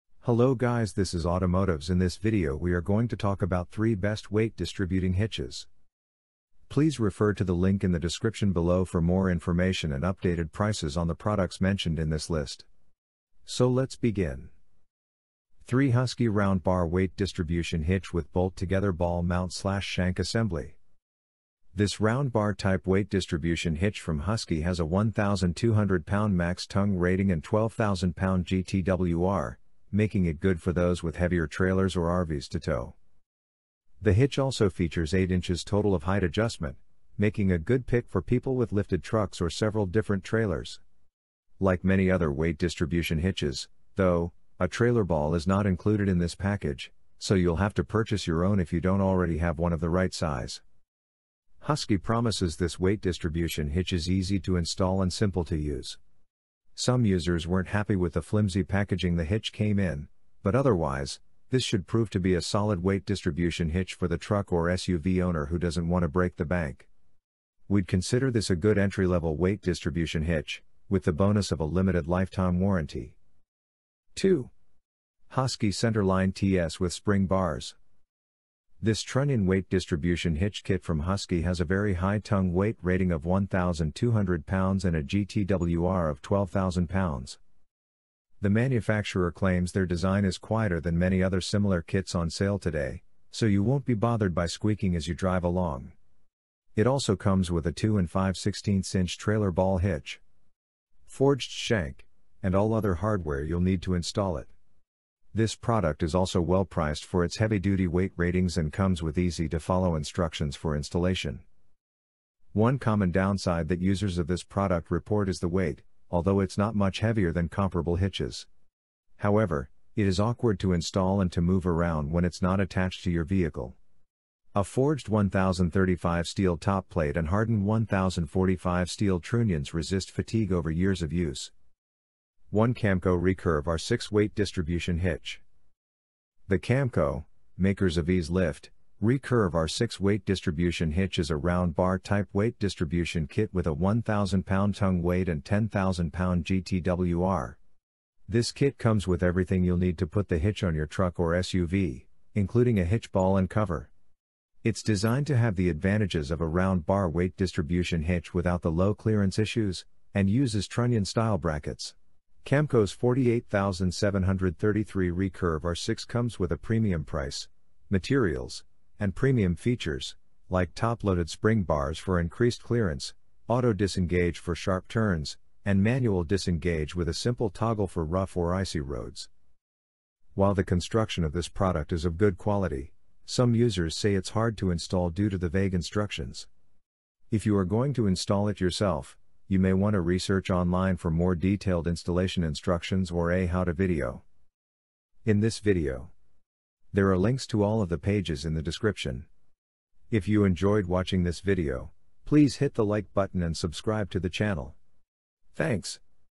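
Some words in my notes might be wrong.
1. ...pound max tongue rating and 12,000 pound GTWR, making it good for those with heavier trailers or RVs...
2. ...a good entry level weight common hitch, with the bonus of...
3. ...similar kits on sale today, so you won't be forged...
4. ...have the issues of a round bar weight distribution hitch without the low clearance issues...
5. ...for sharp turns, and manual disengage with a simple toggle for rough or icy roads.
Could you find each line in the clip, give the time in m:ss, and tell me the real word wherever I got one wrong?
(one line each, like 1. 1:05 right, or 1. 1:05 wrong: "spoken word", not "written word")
1. 0:26 right
2. 1:08 wrong: "distribution", not "common"
3. 1:31 wrong: "bothered", not "forged"
4. 2:35 wrong: "advantages", not "issues"
5. 2:54 right.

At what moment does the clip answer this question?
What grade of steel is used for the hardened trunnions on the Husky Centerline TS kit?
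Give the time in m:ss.
2:07.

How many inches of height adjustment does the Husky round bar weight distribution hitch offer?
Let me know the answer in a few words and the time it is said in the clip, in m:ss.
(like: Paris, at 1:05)
8 inches, at 0:35.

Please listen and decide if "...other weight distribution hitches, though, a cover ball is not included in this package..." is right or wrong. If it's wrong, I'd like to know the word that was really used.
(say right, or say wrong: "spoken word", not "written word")
wrong: "trailer", not "cover".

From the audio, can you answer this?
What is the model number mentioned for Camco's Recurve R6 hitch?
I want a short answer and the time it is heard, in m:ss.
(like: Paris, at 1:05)
48733, at 2:42.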